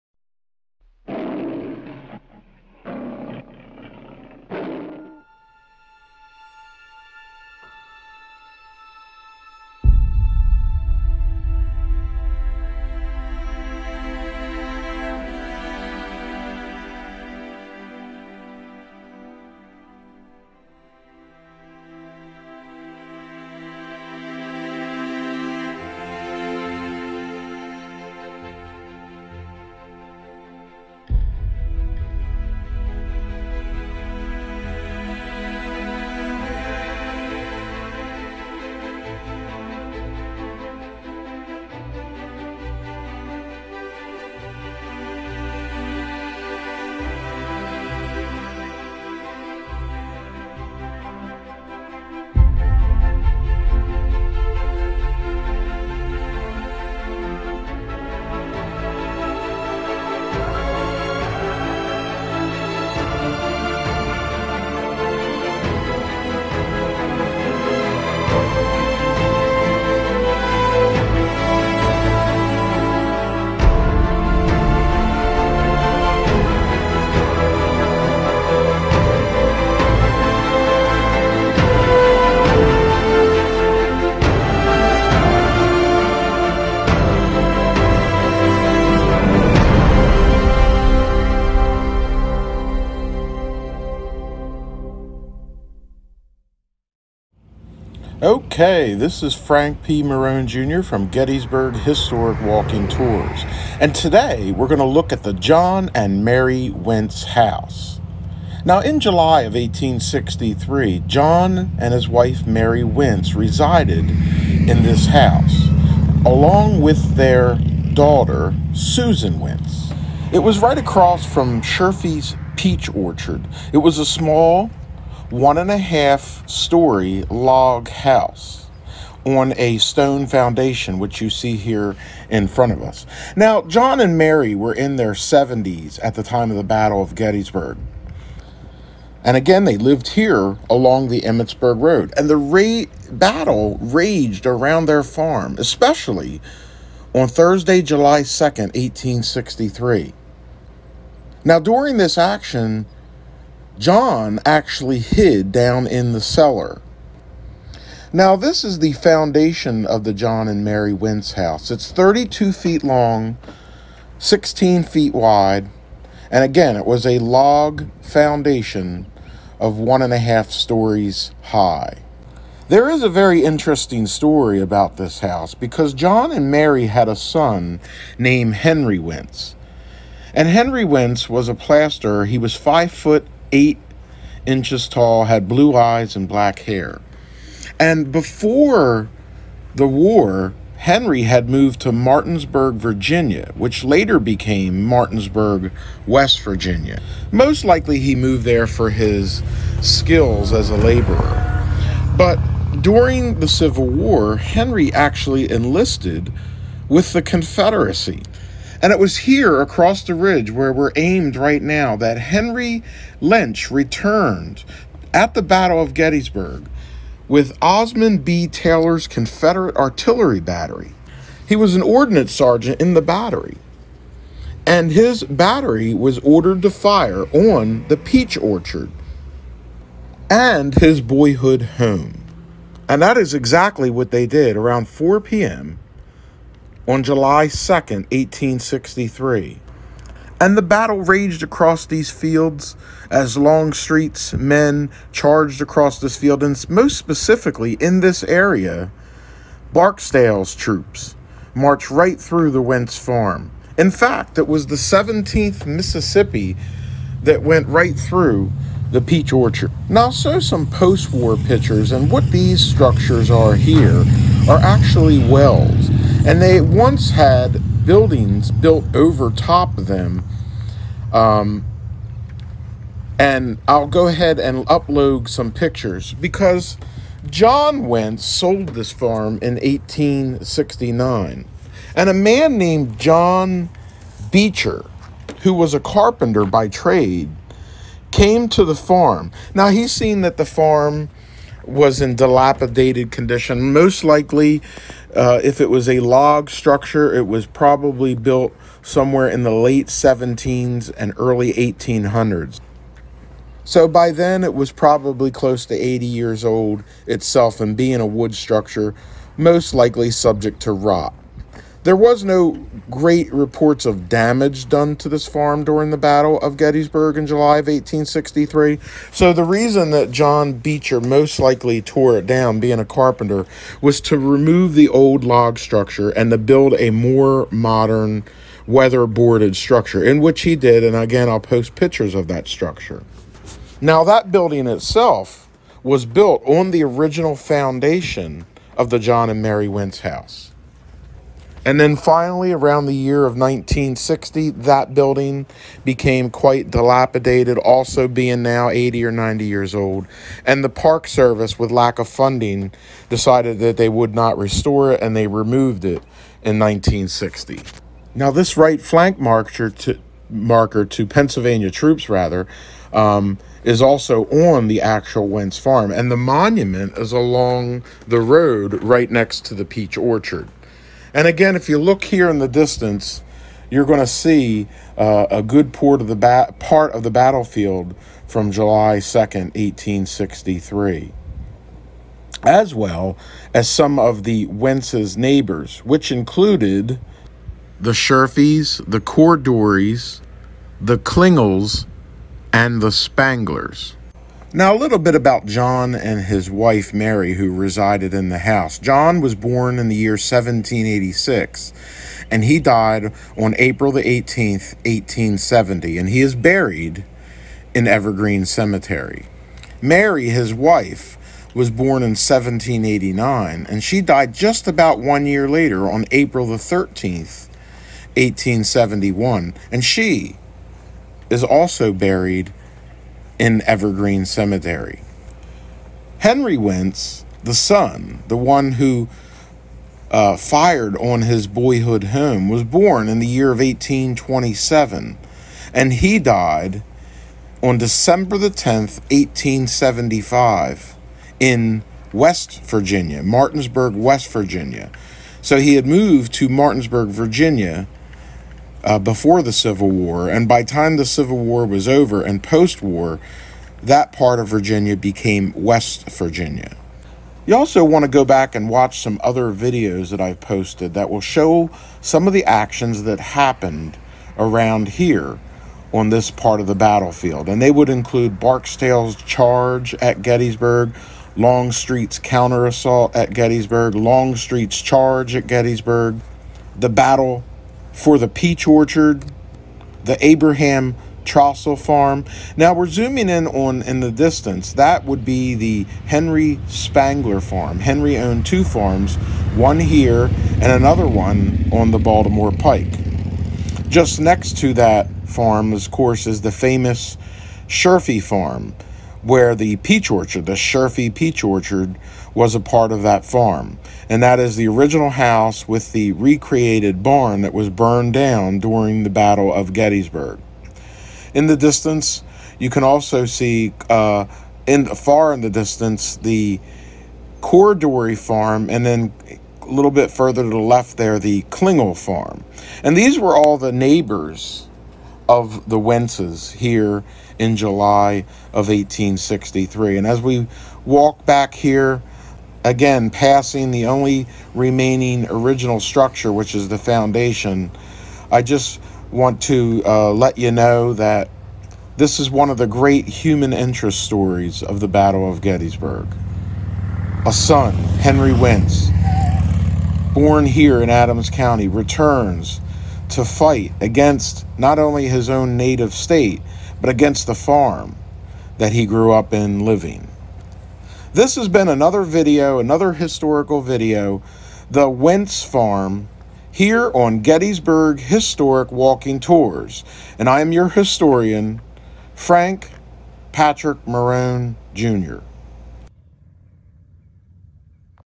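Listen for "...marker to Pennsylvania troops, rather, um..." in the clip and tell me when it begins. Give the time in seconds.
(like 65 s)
360 s.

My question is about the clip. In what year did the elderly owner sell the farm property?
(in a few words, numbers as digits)
1869.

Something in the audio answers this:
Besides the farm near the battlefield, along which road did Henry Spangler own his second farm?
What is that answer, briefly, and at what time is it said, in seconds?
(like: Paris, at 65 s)
Baltimore Pike, at 491 s.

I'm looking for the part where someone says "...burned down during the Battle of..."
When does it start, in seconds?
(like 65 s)
507 s.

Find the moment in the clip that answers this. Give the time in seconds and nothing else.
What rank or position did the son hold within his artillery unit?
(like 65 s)
221 s.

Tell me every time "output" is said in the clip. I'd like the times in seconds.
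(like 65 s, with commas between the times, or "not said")
not said.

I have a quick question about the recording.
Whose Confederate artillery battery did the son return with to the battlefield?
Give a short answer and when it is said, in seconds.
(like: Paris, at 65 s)
Osmond B. Taylor's, at 217 s.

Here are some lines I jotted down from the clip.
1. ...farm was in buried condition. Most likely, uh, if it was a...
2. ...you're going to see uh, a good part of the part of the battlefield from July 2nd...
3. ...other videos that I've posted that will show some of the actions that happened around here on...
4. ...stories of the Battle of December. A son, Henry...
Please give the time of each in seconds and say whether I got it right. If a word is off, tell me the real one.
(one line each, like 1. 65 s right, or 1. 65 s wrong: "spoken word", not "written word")
1. 290 s wrong: "dilapidated", not "buried"
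2. 373 s right
3. 459 s right
4. 544 s wrong: "Gettysburg", not "December".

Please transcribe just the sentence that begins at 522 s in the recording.
And these were all the neighbors of the Wentzes here in July of 1863.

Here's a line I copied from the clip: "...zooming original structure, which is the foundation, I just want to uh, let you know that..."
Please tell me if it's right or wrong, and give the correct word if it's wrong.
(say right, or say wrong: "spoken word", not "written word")
wrong: "remaining", not "zooming".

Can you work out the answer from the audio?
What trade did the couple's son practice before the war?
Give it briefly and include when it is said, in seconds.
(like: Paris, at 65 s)
Plasterer, at 181 s.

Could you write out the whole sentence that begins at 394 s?
Now, a little bit about John and his wife Mary, who resided in the house.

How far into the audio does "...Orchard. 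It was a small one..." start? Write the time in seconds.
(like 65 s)
122 s.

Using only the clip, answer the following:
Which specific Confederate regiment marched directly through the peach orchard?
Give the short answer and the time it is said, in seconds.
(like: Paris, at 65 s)
17th Mississippi, at 254 s.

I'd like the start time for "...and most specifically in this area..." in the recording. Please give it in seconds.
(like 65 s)
246 s.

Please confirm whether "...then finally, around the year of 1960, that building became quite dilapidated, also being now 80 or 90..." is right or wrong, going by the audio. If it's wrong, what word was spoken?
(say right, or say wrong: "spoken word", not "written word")
right.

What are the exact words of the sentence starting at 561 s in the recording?
This has been another video, another historical video, the Wentz Farm, here on Gettysburg Historic Walking Tours.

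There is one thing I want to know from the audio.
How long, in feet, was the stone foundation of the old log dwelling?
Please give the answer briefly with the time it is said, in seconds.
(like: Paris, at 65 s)
32 feet, at 161 s.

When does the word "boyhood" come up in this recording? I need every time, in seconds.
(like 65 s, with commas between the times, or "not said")
231 s, 431 s.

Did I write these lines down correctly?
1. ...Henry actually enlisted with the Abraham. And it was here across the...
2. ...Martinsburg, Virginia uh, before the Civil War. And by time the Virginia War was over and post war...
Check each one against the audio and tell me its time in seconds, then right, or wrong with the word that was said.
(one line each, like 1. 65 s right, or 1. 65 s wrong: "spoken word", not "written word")
1. 204 s wrong: "Confederacy", not "Abraham"
2. 446 s wrong: "Civil", not "Virginia".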